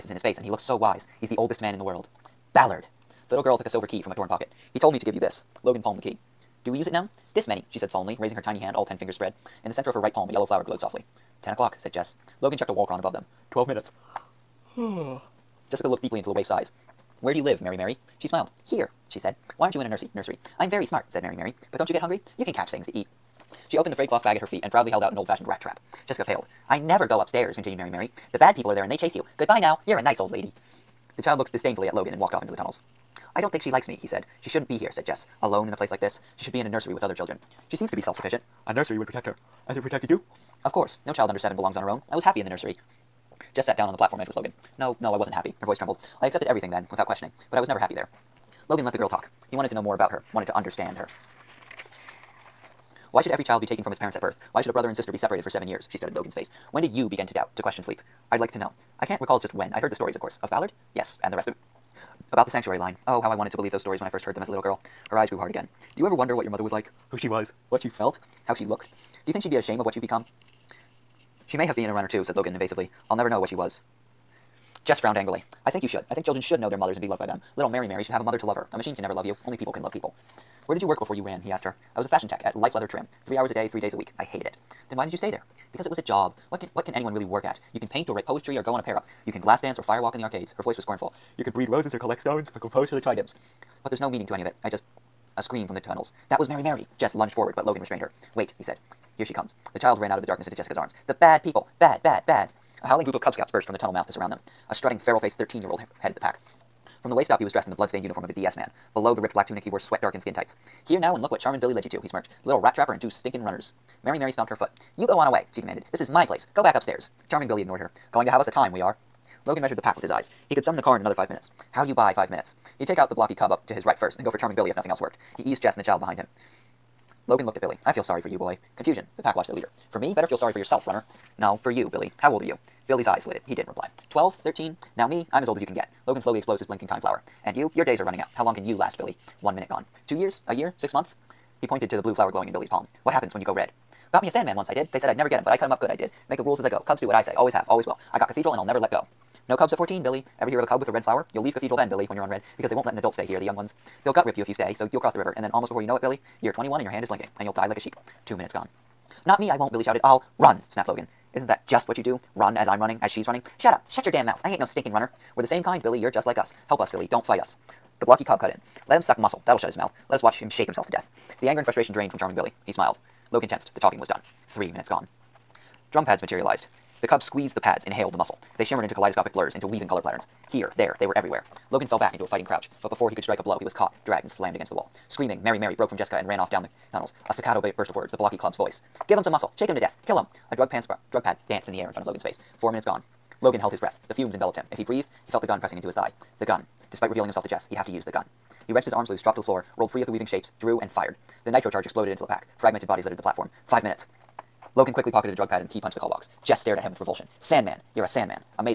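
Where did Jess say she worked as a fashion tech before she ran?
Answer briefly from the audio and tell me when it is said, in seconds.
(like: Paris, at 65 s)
Life Leather Trim, at 82 s.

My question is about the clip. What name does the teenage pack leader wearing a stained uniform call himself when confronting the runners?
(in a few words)
Charmin Billy.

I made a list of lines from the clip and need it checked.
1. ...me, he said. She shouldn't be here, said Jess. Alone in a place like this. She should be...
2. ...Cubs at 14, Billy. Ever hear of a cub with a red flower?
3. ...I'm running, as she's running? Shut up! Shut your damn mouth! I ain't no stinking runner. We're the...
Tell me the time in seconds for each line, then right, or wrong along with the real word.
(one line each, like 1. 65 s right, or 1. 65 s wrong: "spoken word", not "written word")
1. 33 s right
2. 149 s right
3. 162 s right.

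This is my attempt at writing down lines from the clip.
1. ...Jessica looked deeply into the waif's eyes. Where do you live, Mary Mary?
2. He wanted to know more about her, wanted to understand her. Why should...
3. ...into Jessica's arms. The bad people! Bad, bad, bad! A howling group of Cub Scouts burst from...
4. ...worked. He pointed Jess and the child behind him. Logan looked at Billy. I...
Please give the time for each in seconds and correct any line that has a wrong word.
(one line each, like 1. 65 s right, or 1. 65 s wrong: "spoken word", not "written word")
1. 15 s right
2. 49 s right
3. 100 s right
4. 124 s wrong: "eased", not "pointed".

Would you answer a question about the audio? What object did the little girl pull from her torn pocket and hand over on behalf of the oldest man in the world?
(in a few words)
silver key.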